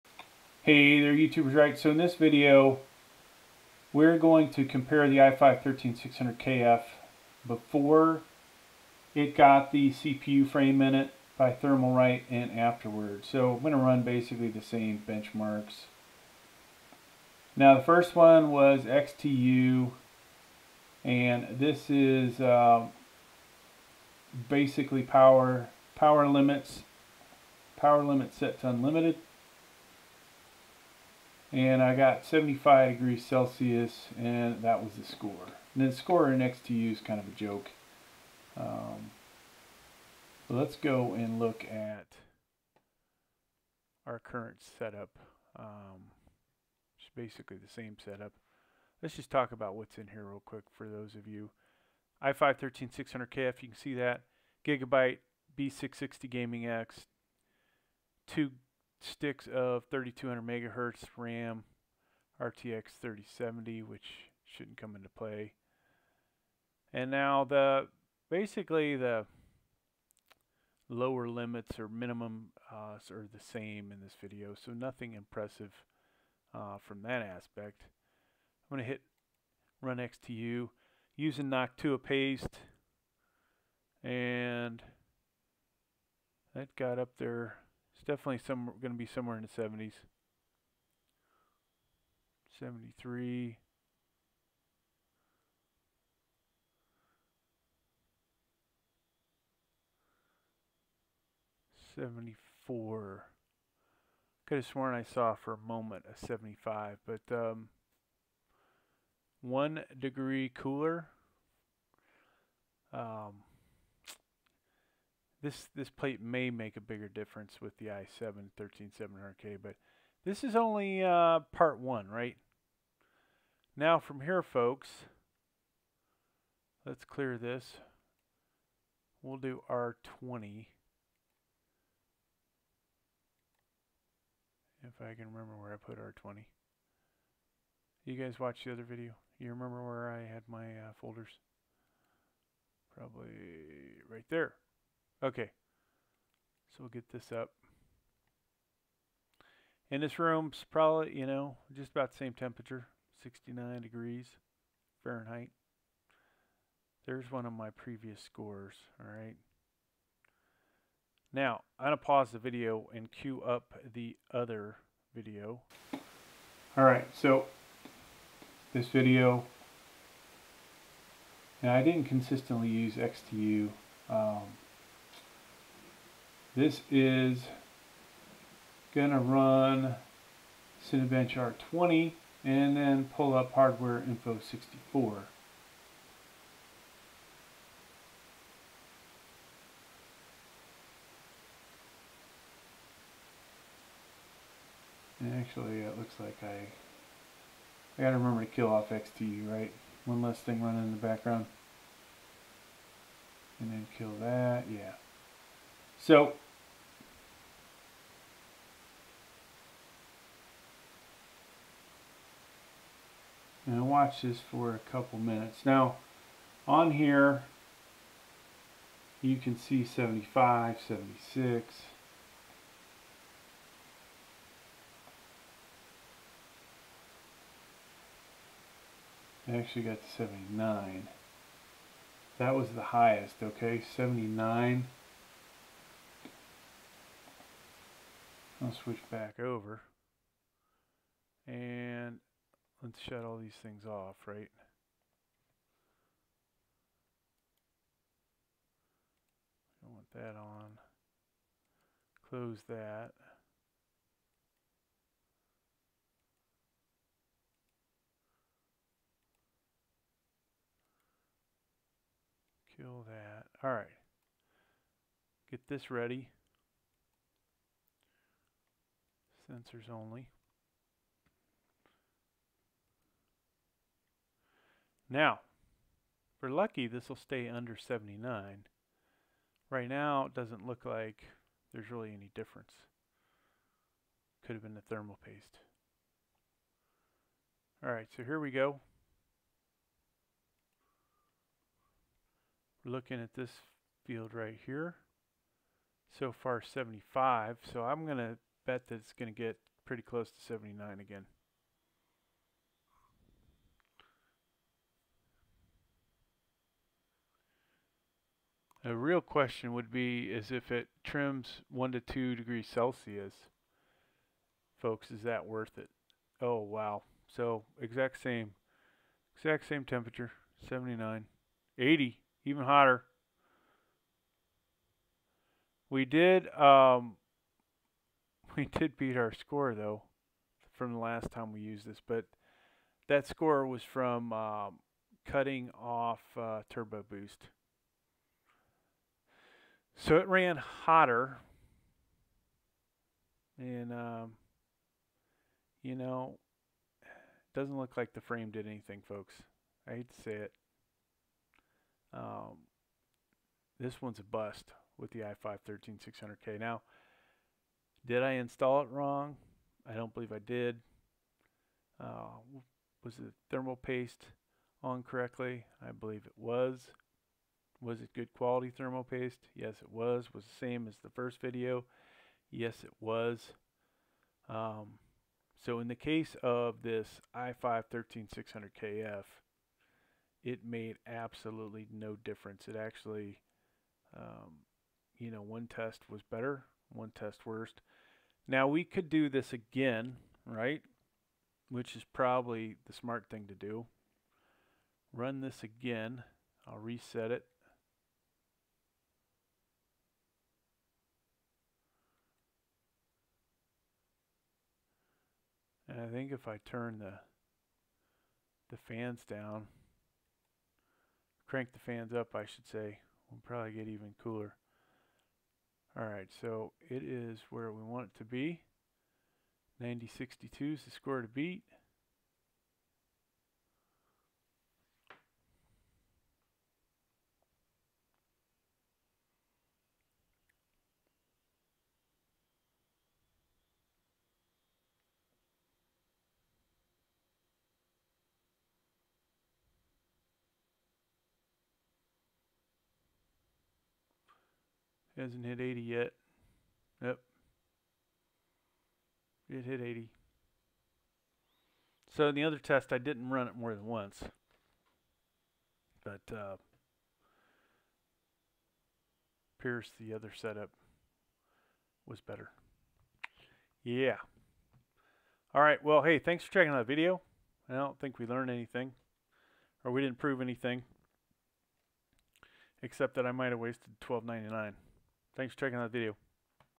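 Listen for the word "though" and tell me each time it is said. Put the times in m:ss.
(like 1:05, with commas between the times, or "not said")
5:29.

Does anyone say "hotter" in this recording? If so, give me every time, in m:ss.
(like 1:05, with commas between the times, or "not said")
5:22, 5:40.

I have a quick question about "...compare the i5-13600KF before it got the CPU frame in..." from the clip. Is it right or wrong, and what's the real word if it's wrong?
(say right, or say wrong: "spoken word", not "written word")
right.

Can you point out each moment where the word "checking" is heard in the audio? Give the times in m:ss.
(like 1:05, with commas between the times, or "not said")
7:46, 7:55.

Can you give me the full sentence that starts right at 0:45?
Um, it's basically the same setup.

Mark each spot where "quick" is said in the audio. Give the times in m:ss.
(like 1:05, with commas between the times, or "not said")
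0:50.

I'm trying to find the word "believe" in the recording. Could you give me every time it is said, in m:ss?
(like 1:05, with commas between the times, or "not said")
6:00, 6:05.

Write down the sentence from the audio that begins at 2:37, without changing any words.
There's one of my previous scores, all right?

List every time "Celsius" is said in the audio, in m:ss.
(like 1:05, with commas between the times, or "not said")
0:33, 5:12.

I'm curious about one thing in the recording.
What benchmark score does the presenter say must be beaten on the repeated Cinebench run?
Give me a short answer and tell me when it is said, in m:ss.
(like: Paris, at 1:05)
9062, at 6:59.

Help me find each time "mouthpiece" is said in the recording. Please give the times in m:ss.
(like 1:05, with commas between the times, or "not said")
not said.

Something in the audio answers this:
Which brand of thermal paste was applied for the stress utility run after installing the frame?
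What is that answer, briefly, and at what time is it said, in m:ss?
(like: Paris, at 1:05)
Noctua, at 1:21.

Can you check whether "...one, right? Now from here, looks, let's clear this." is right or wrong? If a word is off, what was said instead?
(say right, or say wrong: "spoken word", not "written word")
wrong: "folks", not "looks".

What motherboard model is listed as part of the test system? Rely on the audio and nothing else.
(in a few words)
Gigabyte B660 Gaming X.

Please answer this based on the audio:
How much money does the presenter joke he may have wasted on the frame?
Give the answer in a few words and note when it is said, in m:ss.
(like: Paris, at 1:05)
$12.99, at 7:54.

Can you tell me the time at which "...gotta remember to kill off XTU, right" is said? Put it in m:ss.
3:18.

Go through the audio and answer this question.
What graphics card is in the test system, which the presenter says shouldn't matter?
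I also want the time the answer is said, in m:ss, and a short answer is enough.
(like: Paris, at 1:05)
RTX 3070, at 1:02.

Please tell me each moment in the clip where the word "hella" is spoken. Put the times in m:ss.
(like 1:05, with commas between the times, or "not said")
not said.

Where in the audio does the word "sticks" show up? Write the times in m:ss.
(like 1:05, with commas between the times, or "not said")
0:59.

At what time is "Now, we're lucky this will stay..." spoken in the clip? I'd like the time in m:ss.
4:35.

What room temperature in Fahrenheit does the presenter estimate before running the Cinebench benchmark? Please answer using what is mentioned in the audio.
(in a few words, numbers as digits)
69 degrees.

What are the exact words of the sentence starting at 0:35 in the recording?
And the score next to you is kind of a joke.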